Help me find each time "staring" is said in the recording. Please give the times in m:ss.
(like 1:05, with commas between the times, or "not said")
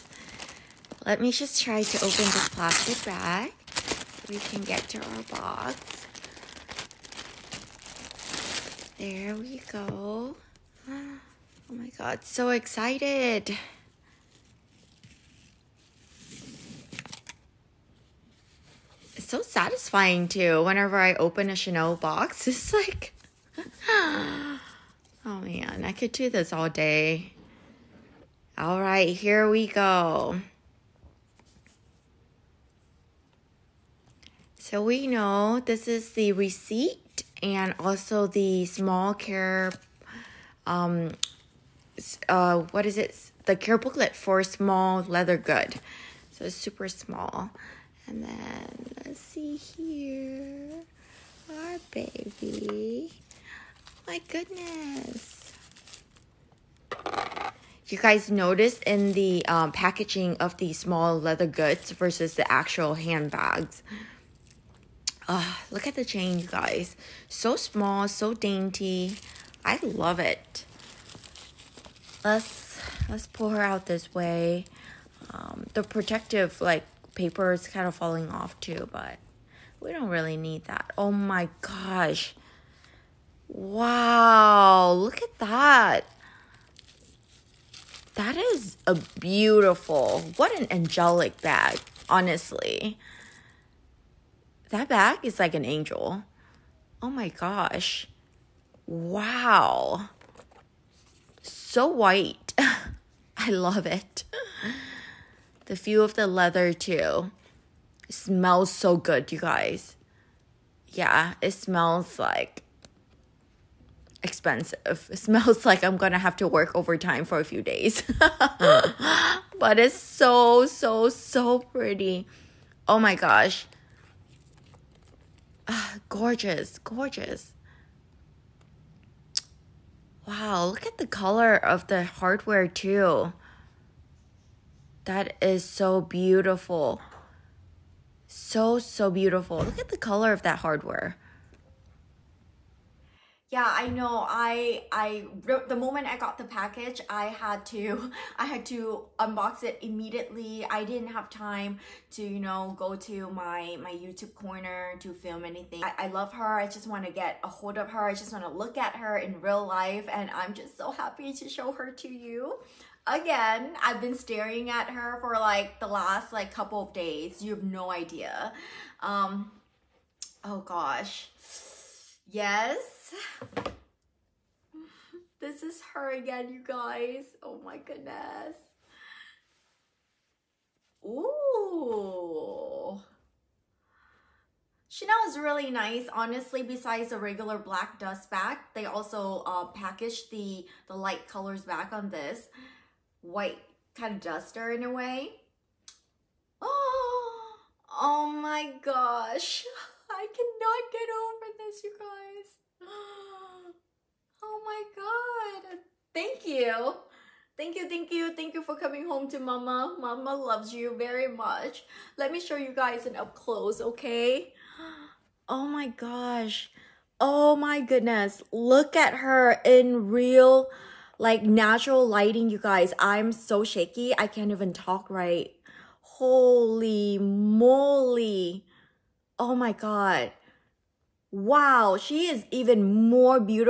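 2:44.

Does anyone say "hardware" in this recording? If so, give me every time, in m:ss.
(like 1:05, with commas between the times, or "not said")
2:12, 2:20.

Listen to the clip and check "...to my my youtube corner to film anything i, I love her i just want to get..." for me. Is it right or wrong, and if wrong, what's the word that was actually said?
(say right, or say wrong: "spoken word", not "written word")
right.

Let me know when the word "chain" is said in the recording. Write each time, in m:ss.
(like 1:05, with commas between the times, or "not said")
1:06.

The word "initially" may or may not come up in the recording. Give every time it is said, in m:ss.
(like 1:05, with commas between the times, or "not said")
not said.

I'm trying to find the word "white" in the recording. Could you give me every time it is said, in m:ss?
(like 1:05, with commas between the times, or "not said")
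1:41, 3:13.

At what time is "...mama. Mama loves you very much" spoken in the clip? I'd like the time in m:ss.
3:29.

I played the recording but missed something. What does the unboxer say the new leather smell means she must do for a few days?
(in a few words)
work overtime.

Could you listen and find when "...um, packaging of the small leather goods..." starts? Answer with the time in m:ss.
0:59.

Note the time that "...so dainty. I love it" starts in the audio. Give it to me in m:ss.
1:08.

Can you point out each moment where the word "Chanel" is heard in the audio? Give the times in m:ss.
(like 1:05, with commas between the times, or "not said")
0:21, 3:04.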